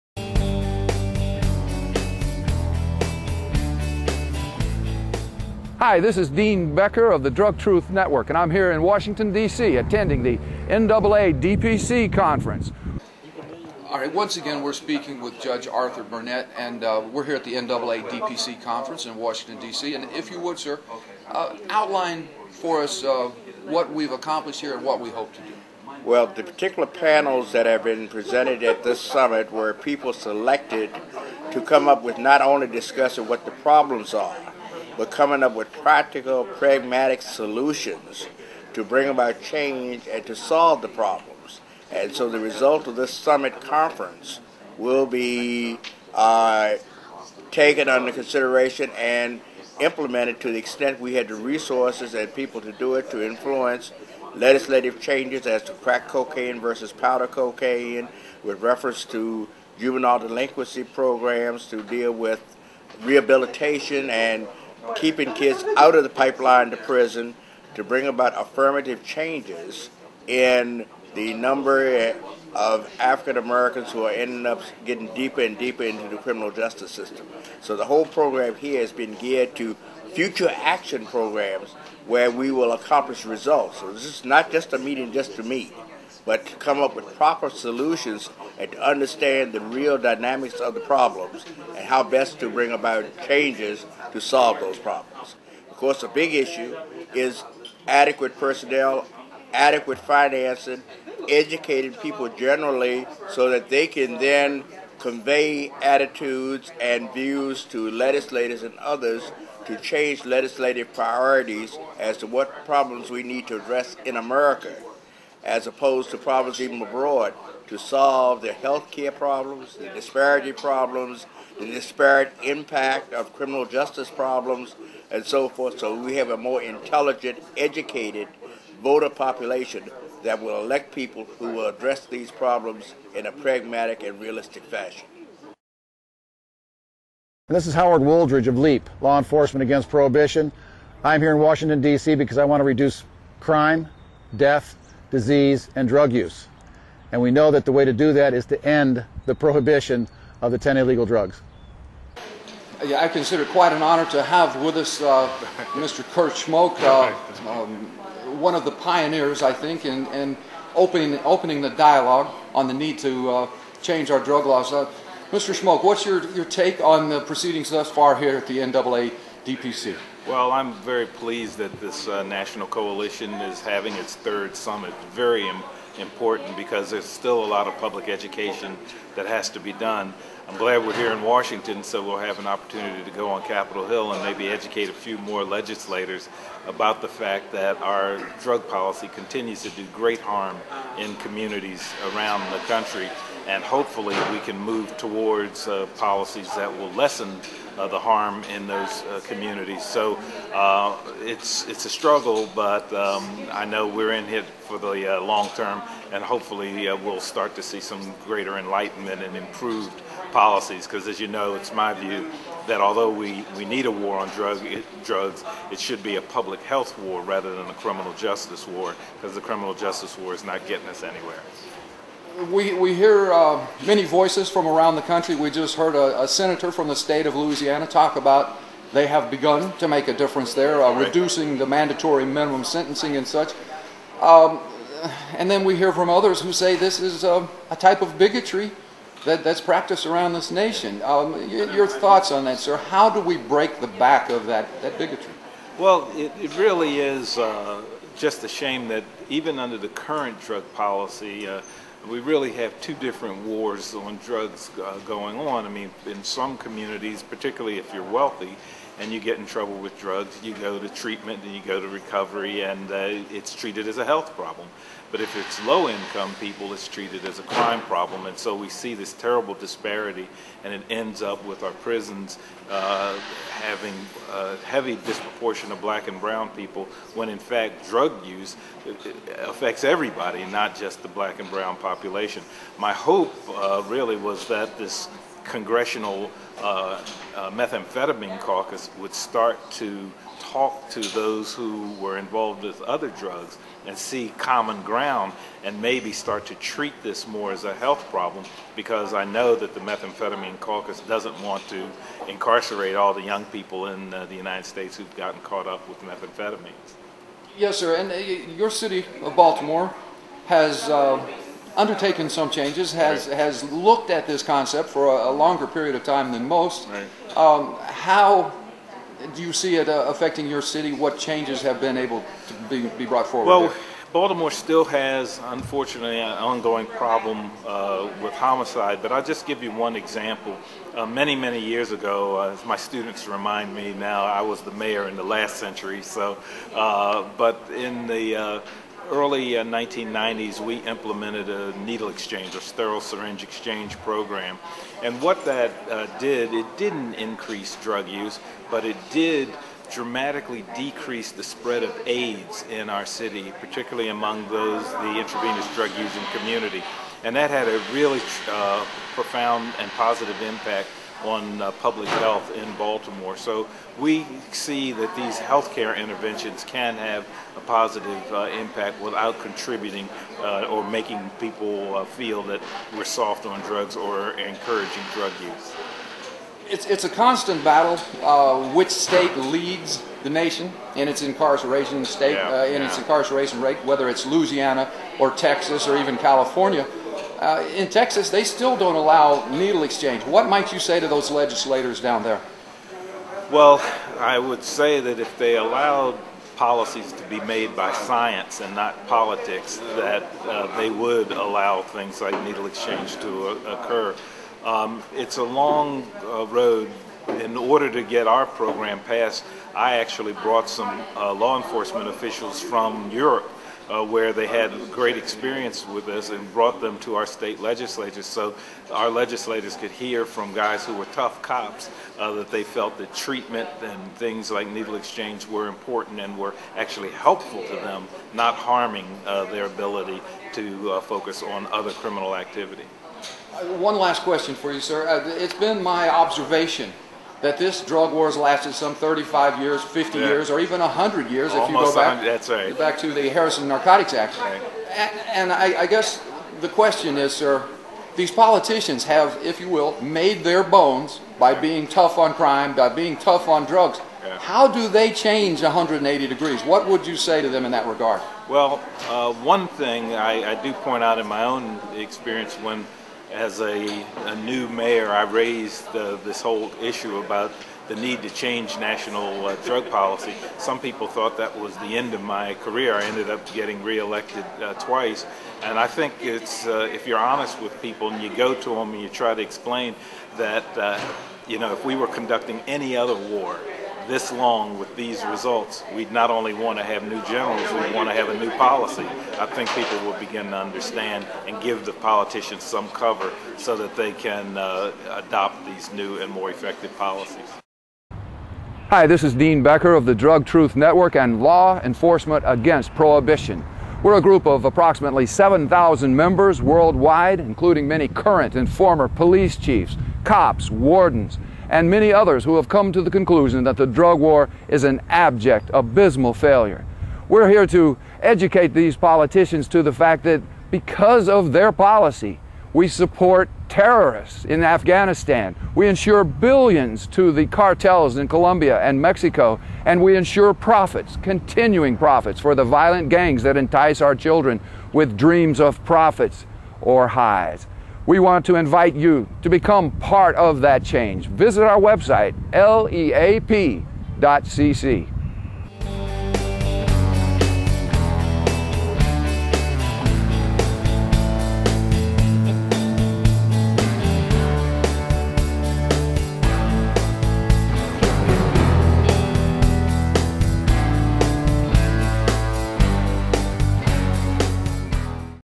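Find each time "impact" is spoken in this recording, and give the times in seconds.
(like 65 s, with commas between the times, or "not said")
122 s, 360 s, 368 s.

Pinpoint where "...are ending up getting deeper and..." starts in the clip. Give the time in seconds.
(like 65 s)
74 s.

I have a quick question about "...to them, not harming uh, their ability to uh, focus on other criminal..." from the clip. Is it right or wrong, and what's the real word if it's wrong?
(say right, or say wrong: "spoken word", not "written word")
right.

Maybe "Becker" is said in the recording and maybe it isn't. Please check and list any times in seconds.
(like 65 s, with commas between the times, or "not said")
6 s, 499 s.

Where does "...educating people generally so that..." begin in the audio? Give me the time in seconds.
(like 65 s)
101 s.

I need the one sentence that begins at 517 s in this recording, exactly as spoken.
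We're here to educate these politicians to the fact that because of their policy, we support terrorists in Afghanistan.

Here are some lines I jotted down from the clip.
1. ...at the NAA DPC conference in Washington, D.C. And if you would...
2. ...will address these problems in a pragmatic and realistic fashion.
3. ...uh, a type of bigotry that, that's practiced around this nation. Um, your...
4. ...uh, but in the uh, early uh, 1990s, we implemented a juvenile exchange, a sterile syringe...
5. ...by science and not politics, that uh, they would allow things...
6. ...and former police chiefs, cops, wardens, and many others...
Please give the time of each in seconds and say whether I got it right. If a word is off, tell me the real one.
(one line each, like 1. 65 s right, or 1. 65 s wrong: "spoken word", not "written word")
1. 17 s right
2. 131 s right
3. 237 s right
4. 336 s wrong: "needle", not "juvenile"
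5. 397 s right
6. 508 s right.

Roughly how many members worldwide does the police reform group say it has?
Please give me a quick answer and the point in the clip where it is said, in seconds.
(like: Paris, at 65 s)
7,000, at 505 s.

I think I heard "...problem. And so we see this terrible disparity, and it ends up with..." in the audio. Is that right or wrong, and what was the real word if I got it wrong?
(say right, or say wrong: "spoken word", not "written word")
right.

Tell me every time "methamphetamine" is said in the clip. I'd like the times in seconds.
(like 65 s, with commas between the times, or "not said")
287 s, 299 s, 306 s.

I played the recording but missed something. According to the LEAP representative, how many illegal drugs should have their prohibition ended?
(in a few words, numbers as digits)
10.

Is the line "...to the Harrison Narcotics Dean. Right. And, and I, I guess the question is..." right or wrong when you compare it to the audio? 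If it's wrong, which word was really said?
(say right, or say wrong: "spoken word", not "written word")
wrong: "Act", not "Dean".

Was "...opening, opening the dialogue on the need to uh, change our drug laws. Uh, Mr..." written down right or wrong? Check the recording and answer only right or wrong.
right.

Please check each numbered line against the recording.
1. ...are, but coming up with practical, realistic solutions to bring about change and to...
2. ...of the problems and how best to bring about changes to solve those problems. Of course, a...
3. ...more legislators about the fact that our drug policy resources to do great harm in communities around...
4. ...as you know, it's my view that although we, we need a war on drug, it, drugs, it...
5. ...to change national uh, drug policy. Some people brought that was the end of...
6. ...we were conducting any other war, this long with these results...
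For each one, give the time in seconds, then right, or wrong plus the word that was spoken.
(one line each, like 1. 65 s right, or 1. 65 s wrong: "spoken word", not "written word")
1. 34 s wrong: "pragmatic", not "realistic"
2. 90 s right
3. 185 s wrong: "continues", not "resources"
4. 211 s right
5. 468 s wrong: "thought", not "brought"
6. 481 s right.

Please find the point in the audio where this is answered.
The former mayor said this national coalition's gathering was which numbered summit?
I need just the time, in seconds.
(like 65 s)
174 s.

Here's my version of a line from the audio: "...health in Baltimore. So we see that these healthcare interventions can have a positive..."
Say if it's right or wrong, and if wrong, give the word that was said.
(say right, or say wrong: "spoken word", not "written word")
right.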